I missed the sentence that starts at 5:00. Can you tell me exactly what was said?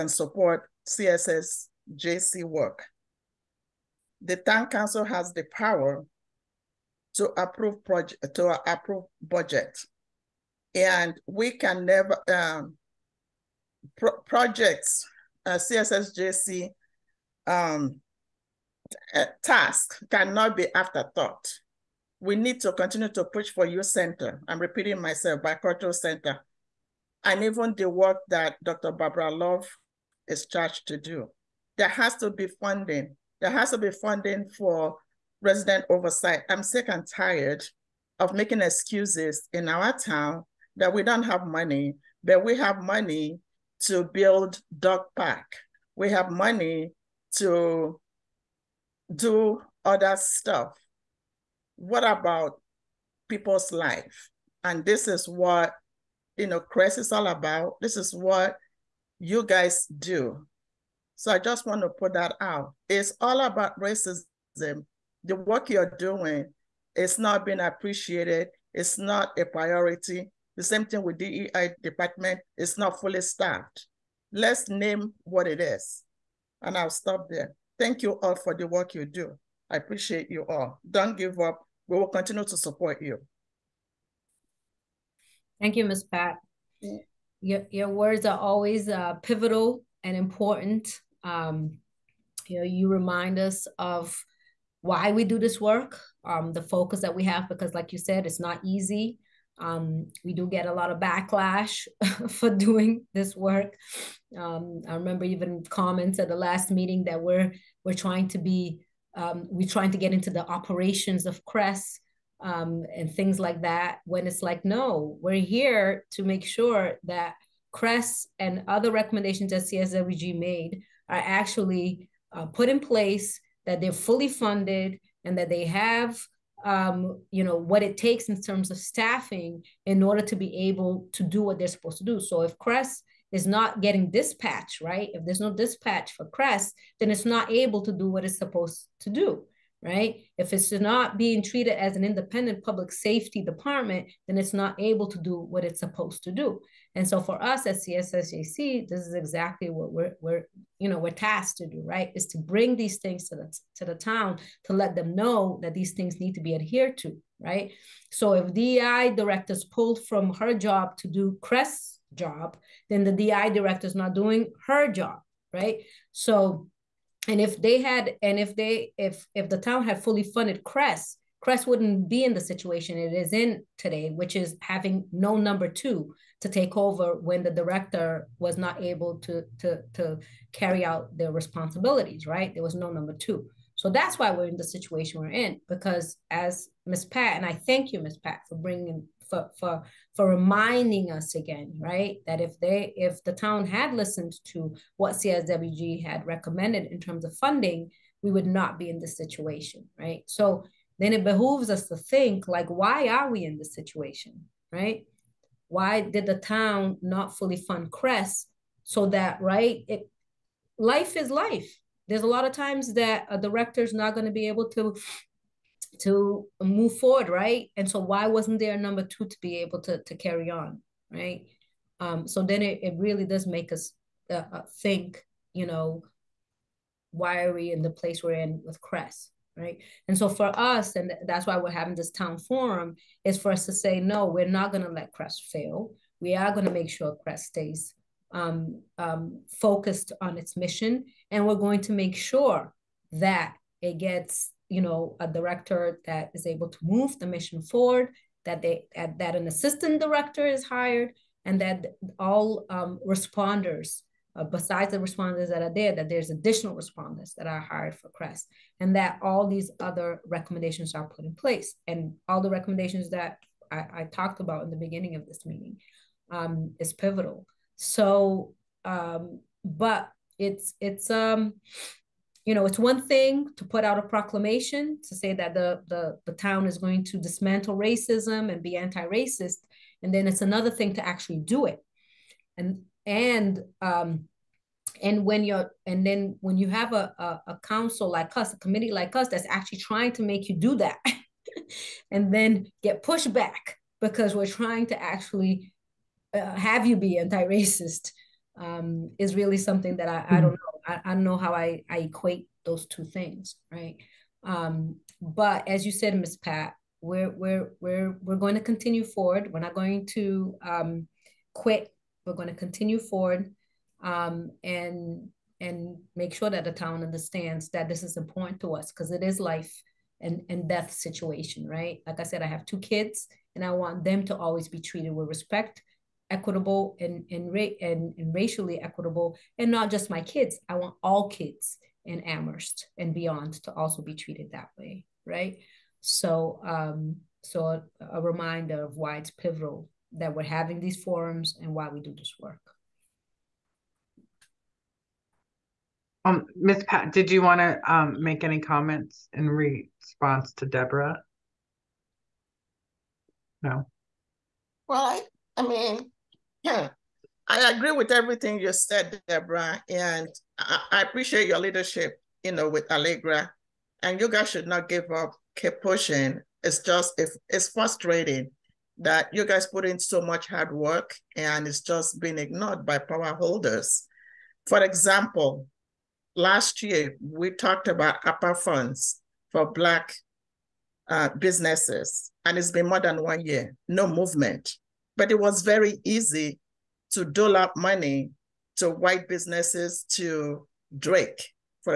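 don't know I, I don't know how I, I equate those two things, right?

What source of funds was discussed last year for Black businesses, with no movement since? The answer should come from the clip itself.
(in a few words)
ARPA funds.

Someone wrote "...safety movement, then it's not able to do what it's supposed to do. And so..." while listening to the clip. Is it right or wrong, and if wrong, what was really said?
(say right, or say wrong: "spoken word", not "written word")
wrong: "department", not "movement".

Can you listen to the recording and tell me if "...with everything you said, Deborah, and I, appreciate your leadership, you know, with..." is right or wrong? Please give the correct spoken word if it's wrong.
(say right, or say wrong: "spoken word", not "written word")
right.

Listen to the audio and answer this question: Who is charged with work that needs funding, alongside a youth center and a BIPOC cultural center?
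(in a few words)
Dr. Barbara Love.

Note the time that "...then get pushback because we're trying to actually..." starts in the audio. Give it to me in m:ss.
4:52.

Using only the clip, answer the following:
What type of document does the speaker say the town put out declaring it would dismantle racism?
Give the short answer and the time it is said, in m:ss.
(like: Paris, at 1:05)
Proclamation, at 4:34.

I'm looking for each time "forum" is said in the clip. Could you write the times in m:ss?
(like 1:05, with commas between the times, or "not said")
3:52, 5:41.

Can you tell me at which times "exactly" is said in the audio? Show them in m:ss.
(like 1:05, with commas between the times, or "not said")
2:29.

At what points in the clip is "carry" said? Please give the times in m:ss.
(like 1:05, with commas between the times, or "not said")
3:00, 3:40.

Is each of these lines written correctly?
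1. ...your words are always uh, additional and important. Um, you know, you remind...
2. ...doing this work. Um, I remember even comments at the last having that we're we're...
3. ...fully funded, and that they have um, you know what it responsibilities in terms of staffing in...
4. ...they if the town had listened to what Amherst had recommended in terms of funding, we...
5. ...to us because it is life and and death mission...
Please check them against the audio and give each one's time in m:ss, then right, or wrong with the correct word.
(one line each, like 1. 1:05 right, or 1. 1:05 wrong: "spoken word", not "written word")
1. 1:27 wrong: "pivotal", not "additional"
2. 1:42 wrong: "meeting", not "having"
3. 2:03 wrong: "takes", not "responsibilities"
4. 3:12 wrong: "CSWG", not "Amherst"
5. 5:18 wrong: "situation", not "mission".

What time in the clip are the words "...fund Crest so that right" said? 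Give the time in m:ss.
3:27.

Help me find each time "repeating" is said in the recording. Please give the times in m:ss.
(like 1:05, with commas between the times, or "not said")
0:24.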